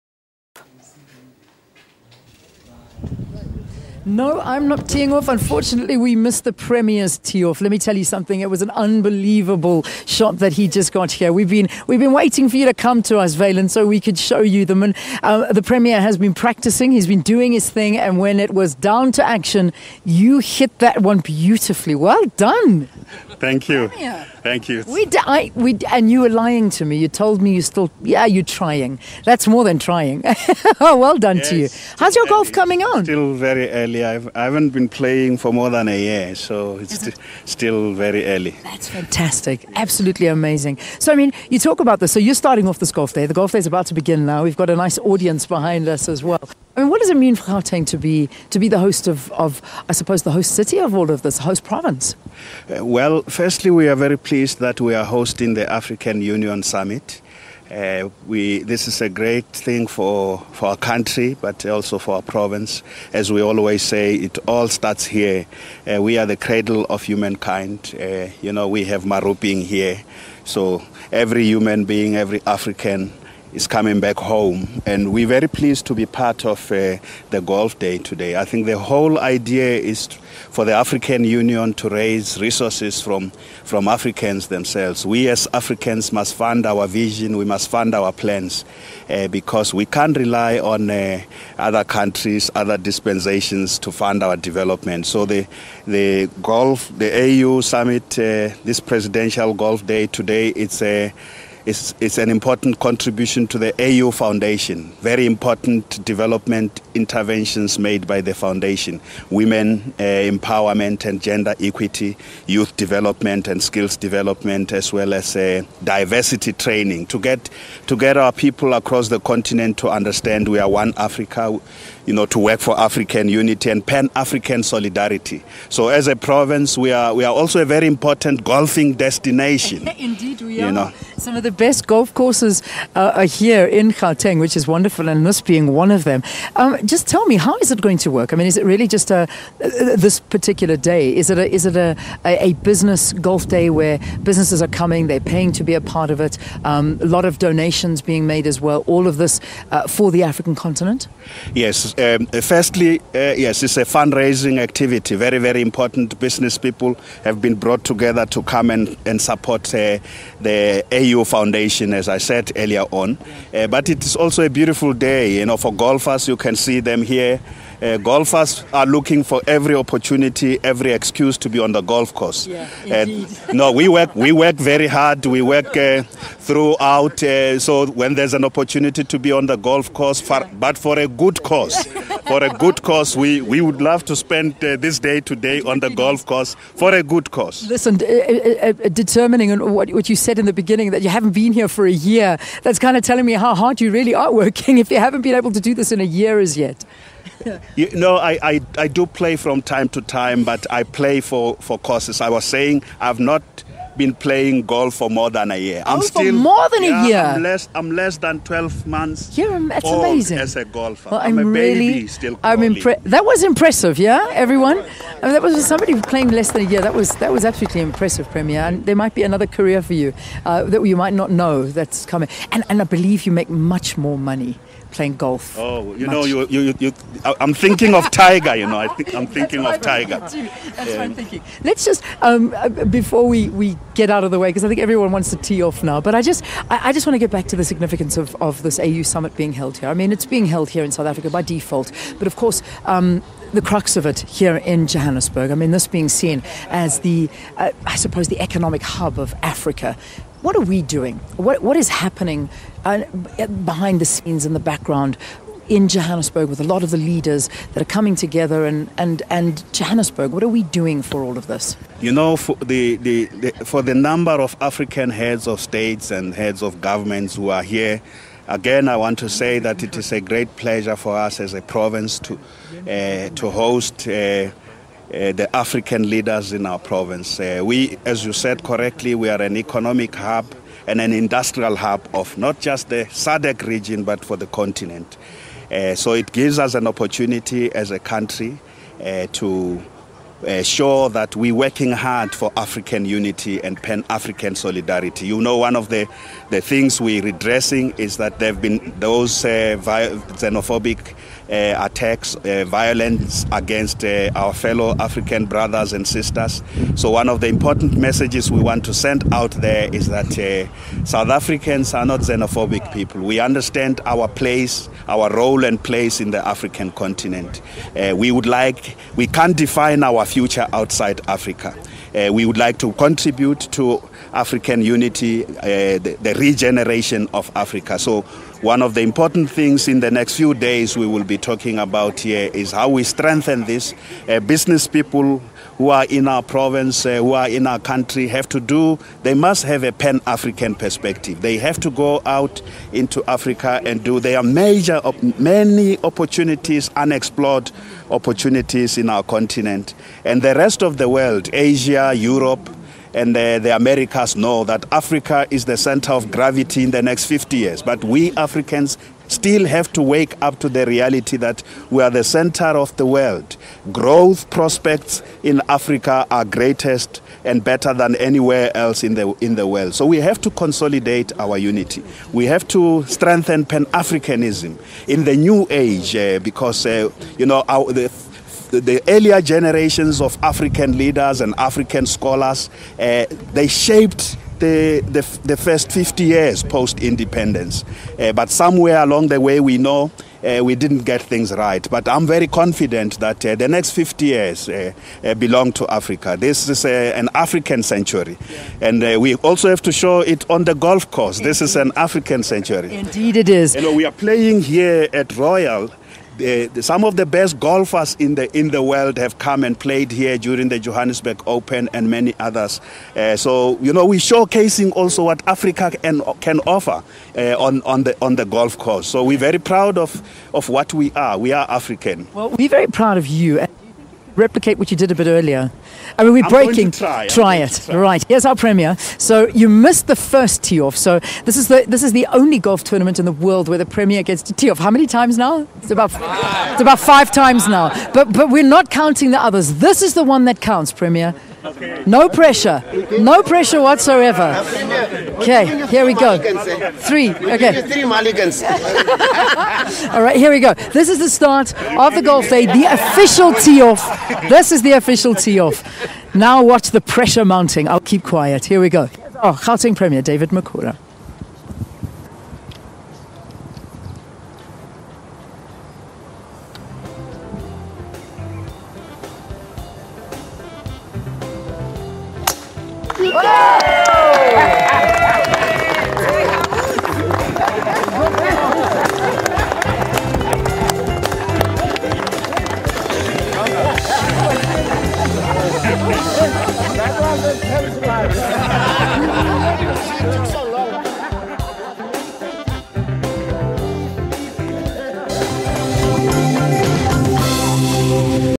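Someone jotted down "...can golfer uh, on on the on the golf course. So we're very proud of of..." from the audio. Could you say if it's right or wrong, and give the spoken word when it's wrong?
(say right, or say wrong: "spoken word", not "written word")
wrong: "offer", not "golfer".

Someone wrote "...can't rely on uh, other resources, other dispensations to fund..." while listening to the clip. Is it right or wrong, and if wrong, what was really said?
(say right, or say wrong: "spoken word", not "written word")
wrong: "countries", not "resources".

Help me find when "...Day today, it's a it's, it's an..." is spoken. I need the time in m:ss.
1:39.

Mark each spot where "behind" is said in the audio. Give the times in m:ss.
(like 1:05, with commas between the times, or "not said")
0:45, 4:13.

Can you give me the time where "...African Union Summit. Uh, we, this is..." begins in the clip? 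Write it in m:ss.
0:55.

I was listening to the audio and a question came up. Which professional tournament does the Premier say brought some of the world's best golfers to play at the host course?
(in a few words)
Johannesburg Open.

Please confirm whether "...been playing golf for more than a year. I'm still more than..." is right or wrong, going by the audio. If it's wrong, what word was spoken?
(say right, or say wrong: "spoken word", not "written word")
right.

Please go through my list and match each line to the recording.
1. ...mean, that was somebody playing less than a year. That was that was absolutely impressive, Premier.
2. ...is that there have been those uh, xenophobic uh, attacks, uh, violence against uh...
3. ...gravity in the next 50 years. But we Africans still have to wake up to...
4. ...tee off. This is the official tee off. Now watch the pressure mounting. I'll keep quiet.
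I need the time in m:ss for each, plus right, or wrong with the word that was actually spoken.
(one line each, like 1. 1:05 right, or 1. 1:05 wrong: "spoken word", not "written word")
1. 3:35 right
2. 4:57 right
3. 5:56 right
4. 7:33 right.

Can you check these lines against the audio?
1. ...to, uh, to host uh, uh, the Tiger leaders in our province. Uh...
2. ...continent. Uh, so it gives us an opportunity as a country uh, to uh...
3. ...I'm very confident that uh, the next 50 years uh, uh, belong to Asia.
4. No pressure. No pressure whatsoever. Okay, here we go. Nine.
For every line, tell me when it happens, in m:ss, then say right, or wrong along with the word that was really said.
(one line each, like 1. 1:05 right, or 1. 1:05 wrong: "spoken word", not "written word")
1. 4:32 wrong: "African", not "Tiger"
2. 4:44 right
3. 6:32 wrong: "Africa", not "Asia"
4. 7:22 wrong: "Three", not "Nine".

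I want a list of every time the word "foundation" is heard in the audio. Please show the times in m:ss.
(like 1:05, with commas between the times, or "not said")
1:44, 1:48, 2:41.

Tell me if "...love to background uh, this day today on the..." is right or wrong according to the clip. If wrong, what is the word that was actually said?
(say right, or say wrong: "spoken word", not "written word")
wrong: "spend", not "background".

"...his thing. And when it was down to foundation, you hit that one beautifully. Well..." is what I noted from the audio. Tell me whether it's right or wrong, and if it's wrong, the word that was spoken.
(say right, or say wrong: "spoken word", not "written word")
wrong: "action", not "foundation".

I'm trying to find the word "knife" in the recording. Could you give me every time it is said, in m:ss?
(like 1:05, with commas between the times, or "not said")
not said.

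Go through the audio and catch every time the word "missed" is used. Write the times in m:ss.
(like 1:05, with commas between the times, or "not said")
0:06, 7:09.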